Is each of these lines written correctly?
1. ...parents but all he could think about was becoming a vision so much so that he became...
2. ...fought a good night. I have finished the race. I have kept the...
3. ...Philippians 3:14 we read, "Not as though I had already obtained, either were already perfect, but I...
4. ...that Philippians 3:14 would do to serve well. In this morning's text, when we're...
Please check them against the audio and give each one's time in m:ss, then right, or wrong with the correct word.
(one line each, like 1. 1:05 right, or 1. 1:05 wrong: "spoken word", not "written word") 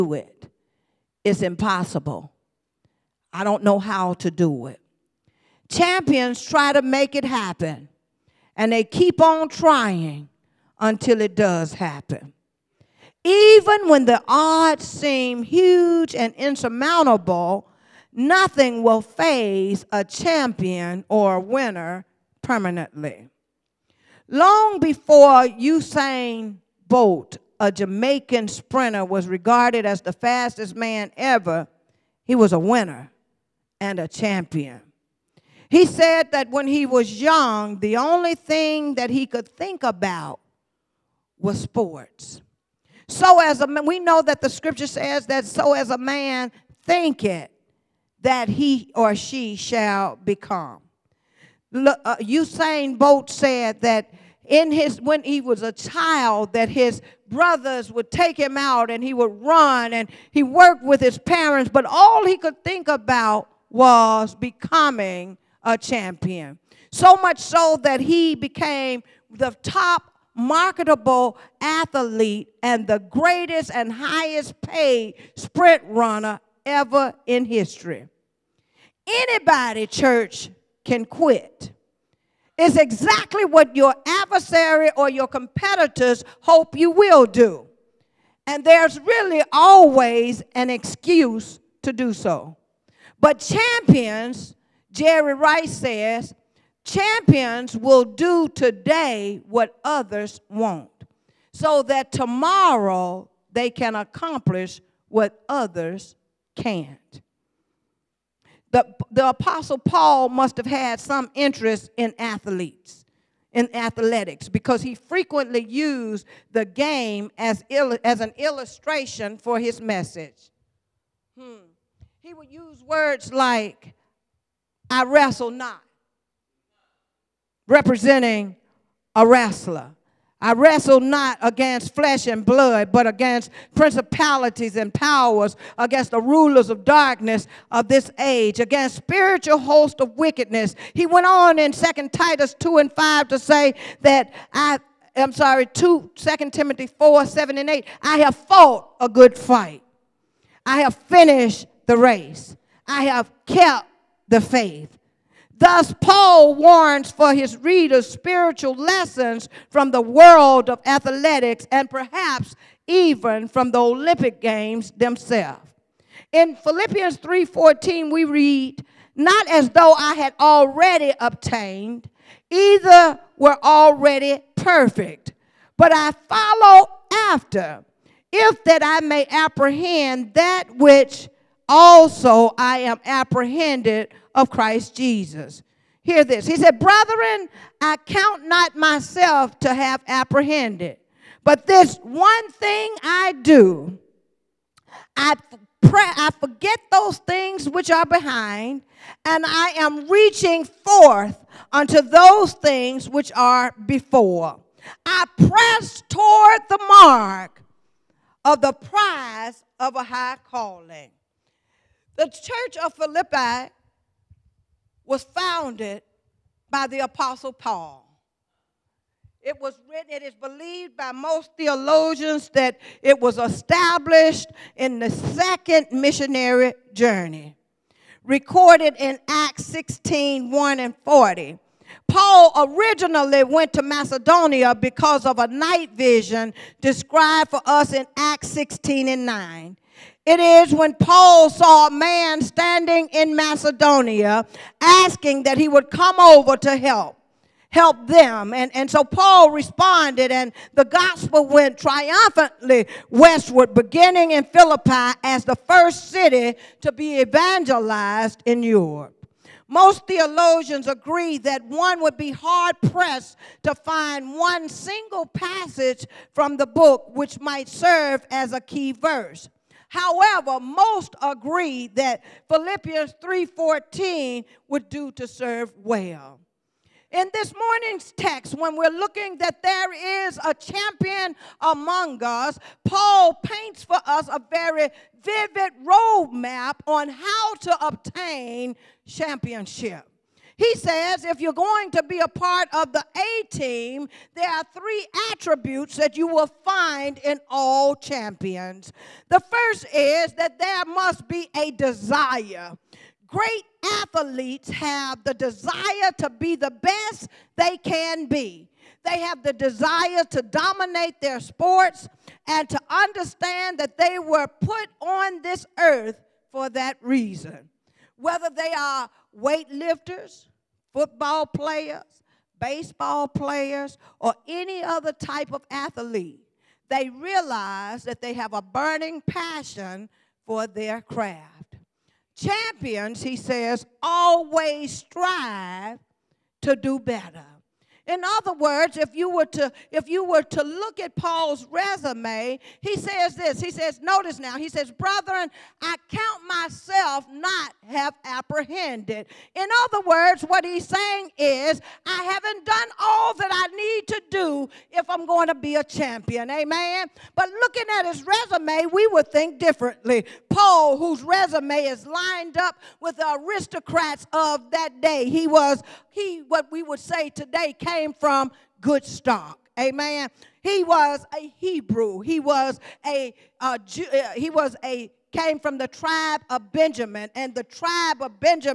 1. 1:01 wrong: "champion", not "vision"
2. 2:28 wrong: "fight", not "night"
3. 2:46 right
4. 4:32 right.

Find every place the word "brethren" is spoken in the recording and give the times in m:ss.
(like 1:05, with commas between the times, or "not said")
3:06, 5:44.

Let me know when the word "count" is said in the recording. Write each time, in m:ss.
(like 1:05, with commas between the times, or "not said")
3:08, 5:46.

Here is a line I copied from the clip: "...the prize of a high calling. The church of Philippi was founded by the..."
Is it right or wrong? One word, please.
right.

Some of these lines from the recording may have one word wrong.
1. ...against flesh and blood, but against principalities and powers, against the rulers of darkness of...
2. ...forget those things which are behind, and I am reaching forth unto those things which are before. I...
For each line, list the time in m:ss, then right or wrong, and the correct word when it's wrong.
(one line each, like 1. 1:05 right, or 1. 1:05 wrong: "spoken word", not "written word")
1. 2:11 right
2. 3:16 right.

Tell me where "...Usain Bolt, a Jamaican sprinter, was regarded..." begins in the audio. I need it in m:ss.
0:25.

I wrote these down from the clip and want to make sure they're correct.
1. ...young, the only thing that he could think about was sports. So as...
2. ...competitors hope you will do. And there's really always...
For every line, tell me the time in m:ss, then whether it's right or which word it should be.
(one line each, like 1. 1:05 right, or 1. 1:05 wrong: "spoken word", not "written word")
1. 0:37 right
2. 1:25 right.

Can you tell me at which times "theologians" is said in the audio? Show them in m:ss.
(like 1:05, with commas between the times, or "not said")
3:41, 4:20.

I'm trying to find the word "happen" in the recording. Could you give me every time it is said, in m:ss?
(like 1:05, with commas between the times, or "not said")
0:07, 0:11.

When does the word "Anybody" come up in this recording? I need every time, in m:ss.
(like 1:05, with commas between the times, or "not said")
1:19.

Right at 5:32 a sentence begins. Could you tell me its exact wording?
Champions, he says, always strive to do better.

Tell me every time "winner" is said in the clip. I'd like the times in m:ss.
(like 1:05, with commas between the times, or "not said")
0:21, 0:32.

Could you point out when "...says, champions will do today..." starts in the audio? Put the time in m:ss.
1:35.